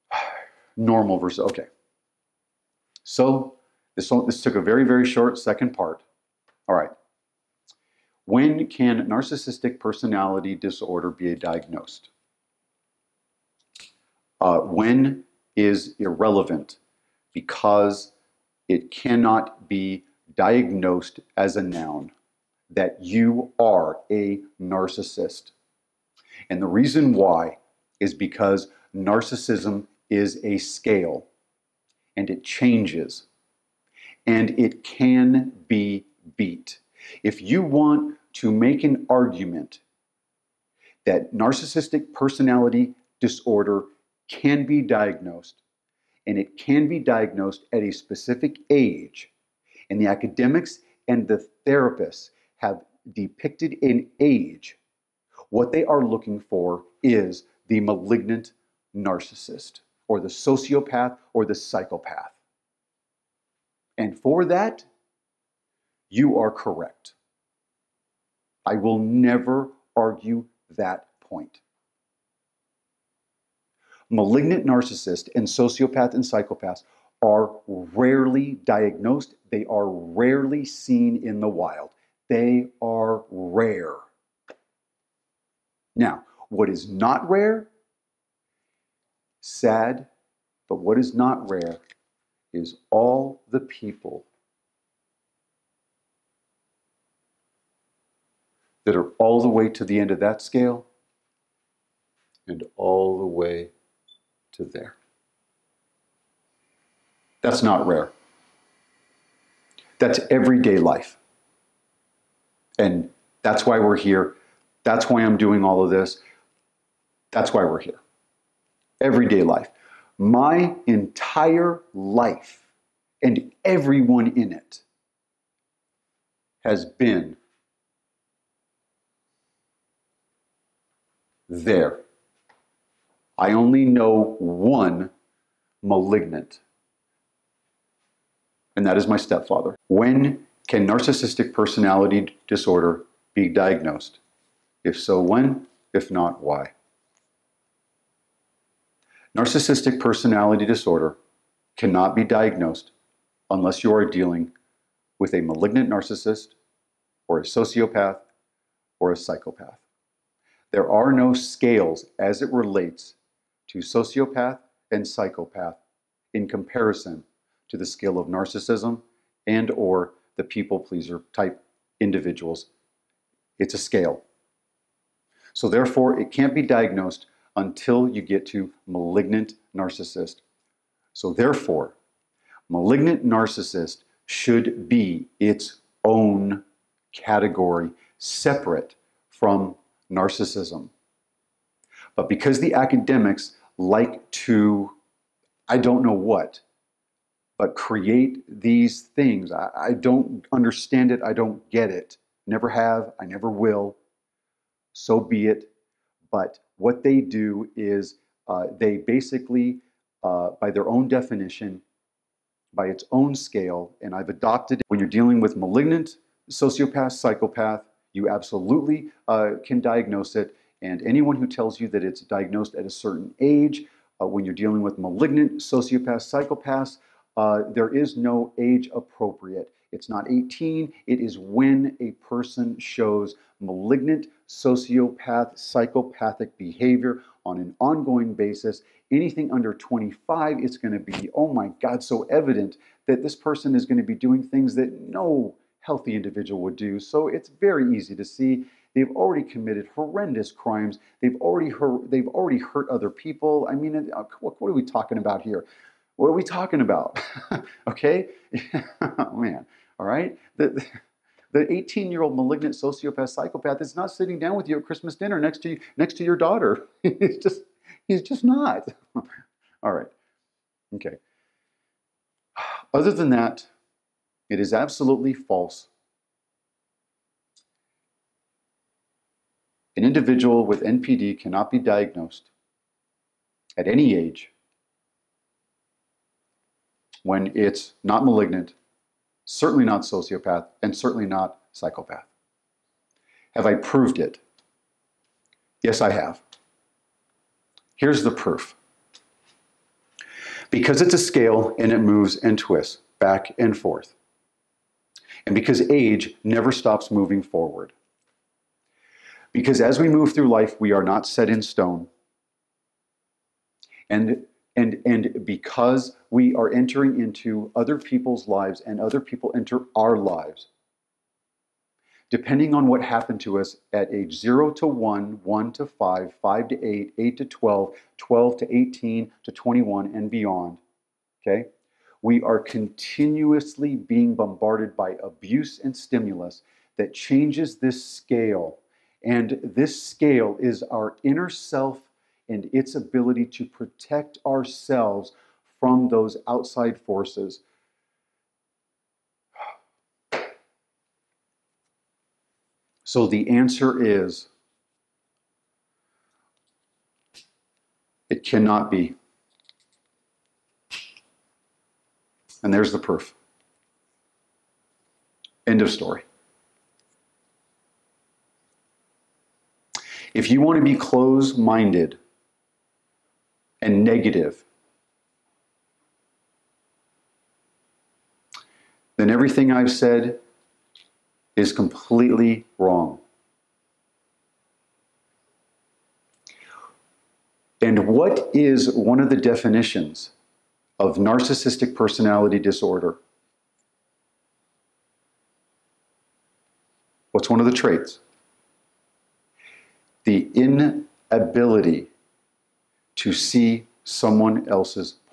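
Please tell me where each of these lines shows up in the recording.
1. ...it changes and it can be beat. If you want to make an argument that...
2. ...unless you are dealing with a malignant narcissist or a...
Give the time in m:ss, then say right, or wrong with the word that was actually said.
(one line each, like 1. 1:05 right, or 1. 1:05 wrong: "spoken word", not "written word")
1. 0:32 right
2. 2:33 right.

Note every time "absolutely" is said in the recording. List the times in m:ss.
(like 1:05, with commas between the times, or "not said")
3:38, 4:34.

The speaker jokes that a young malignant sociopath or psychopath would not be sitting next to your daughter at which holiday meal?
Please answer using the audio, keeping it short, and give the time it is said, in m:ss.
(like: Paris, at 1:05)
Christmas dinner, at 4:24.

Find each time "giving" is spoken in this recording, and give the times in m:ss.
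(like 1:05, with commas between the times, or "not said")
not said.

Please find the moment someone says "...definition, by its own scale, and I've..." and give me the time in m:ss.
3:31.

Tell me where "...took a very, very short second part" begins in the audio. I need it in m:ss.
0:04.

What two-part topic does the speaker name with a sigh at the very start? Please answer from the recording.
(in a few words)
Normal versus okay.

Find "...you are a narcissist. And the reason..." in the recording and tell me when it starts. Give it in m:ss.
0:23.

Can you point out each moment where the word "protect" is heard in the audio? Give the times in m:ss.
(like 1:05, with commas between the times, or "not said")
5:43.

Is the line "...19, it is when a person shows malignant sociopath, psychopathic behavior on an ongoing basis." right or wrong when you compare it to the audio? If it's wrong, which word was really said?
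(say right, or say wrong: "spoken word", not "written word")
wrong: "18", not "19".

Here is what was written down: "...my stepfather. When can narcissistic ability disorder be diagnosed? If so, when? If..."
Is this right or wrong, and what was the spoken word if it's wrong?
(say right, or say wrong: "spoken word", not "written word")
wrong: "personality", not "ability".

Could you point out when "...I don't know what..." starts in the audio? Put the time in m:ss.
3:15.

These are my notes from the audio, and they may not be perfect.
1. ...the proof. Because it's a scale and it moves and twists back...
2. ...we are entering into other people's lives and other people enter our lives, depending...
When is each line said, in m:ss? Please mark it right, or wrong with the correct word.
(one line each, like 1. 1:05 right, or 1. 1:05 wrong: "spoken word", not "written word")
1. 4:58 right
2. 5:16 right.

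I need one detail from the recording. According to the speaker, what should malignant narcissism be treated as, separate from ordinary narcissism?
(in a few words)
Its own category.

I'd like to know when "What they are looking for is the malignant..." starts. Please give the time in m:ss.
0:55.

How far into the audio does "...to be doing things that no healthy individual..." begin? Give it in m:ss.
4:03.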